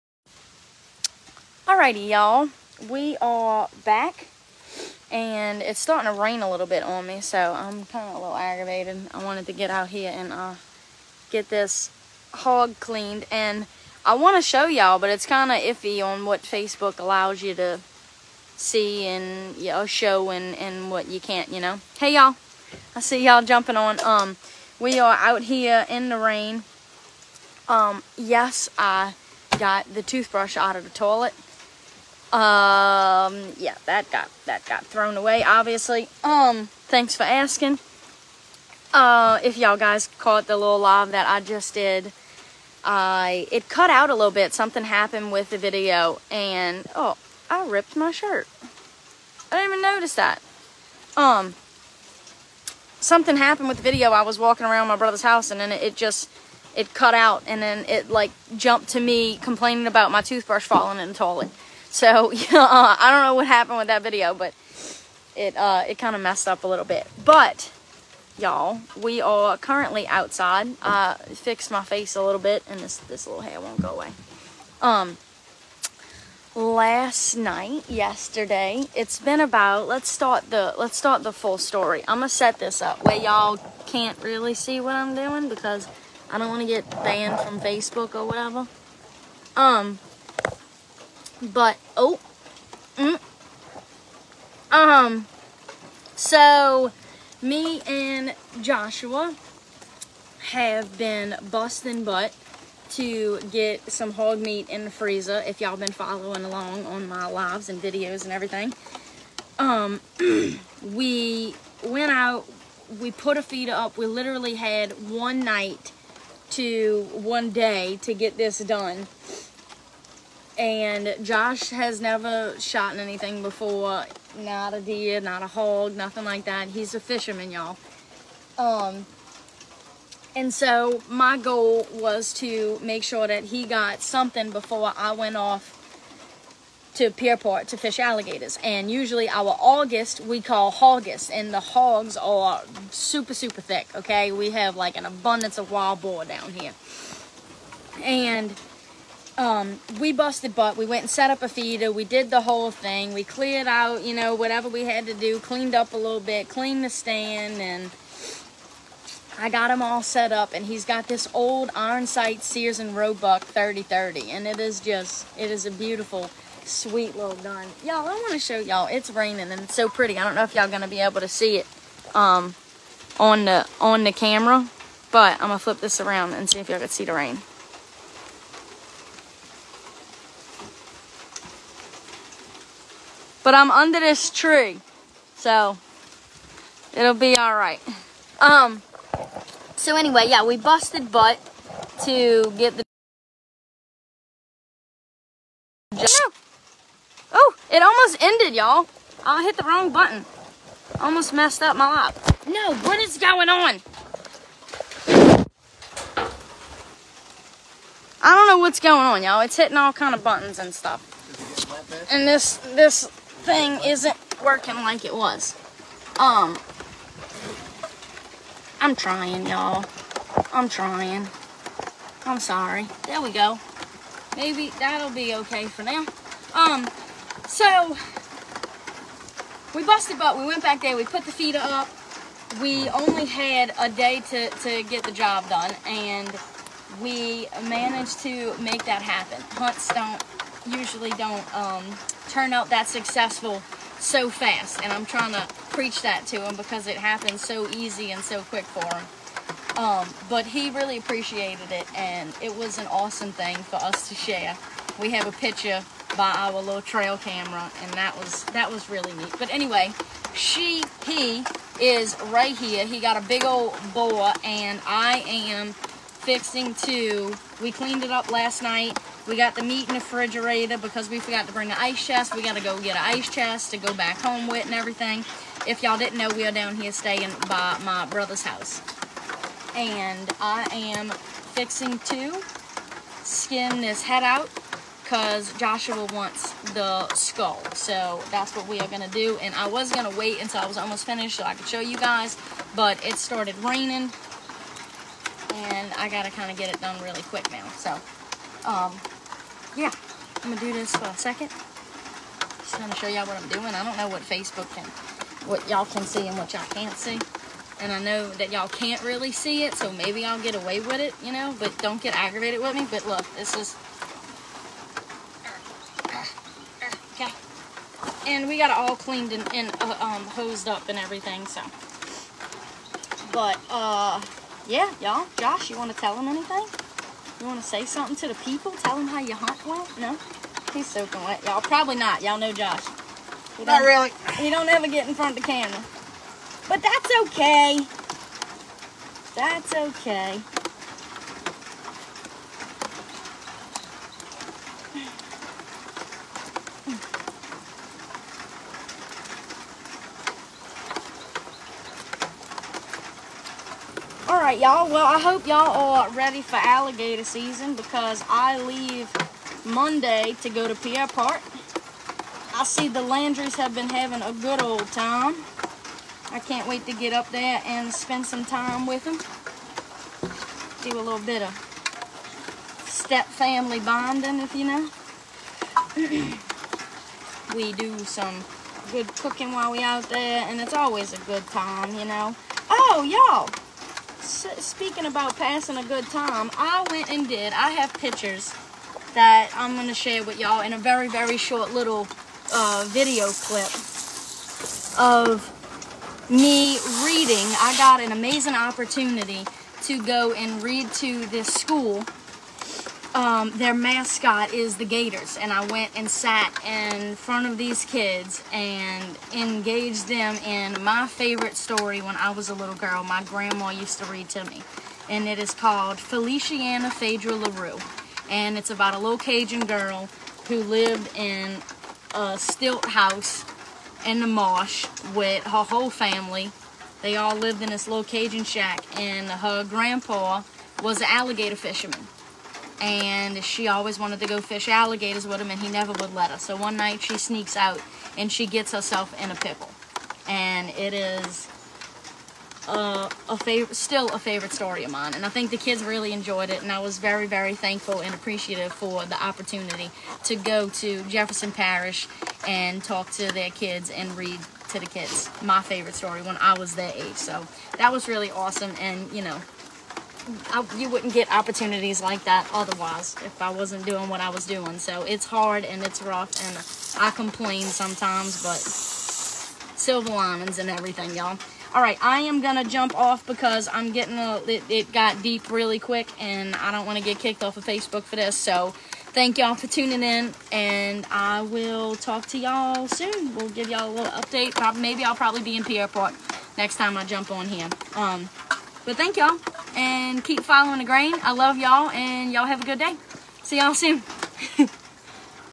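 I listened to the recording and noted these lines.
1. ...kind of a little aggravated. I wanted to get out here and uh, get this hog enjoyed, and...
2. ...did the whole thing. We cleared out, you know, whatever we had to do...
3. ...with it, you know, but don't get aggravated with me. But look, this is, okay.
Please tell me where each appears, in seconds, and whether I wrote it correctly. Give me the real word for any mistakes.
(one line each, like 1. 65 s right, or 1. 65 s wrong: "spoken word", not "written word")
1. 7 s wrong: "cleaned", not "enjoyed"
2. 152 s right
3. 310 s right.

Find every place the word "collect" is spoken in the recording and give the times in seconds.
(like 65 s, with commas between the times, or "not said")
not said.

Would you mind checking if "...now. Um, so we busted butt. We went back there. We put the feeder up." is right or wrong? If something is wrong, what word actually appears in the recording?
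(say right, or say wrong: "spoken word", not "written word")
right.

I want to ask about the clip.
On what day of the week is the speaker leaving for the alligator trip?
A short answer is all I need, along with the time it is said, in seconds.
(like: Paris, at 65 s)
Monday, at 359 s.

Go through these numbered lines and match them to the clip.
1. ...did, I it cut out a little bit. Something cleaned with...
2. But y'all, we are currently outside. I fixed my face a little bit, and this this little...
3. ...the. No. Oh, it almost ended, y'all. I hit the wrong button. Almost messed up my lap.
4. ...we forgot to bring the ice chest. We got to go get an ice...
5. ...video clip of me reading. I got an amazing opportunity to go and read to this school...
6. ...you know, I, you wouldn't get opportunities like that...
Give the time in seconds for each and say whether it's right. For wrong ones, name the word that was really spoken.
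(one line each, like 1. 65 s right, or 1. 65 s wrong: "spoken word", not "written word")
1. 41 s wrong: "happened", not "cleaned"
2. 67 s right
3. 192 s right
4. 271 s right
5. 392 s right
6. 459 s right.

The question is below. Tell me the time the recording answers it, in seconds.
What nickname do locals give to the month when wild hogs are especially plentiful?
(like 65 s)
140 s.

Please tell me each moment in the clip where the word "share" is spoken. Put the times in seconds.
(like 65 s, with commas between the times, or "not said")
254 s, 389 s.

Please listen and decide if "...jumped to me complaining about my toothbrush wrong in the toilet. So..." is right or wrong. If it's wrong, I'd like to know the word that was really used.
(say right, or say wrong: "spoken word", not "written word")
wrong: "falling", not "wrong".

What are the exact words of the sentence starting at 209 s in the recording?
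It's hitting all kind of buttons and stuff.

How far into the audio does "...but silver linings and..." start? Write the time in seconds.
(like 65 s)
468 s.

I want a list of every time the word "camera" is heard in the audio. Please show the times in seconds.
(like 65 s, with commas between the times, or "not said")
174 s, 257 s, 335 s.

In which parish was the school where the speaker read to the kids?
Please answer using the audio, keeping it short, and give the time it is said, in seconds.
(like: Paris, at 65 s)
Jefferson Parish, at 451 s.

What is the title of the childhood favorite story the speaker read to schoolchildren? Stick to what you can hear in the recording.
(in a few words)
Feliciana Feydra LeRoux.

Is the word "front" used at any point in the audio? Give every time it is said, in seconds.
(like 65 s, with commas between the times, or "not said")
335 s, 407 s.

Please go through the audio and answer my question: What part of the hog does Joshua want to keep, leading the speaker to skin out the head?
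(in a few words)
the skull.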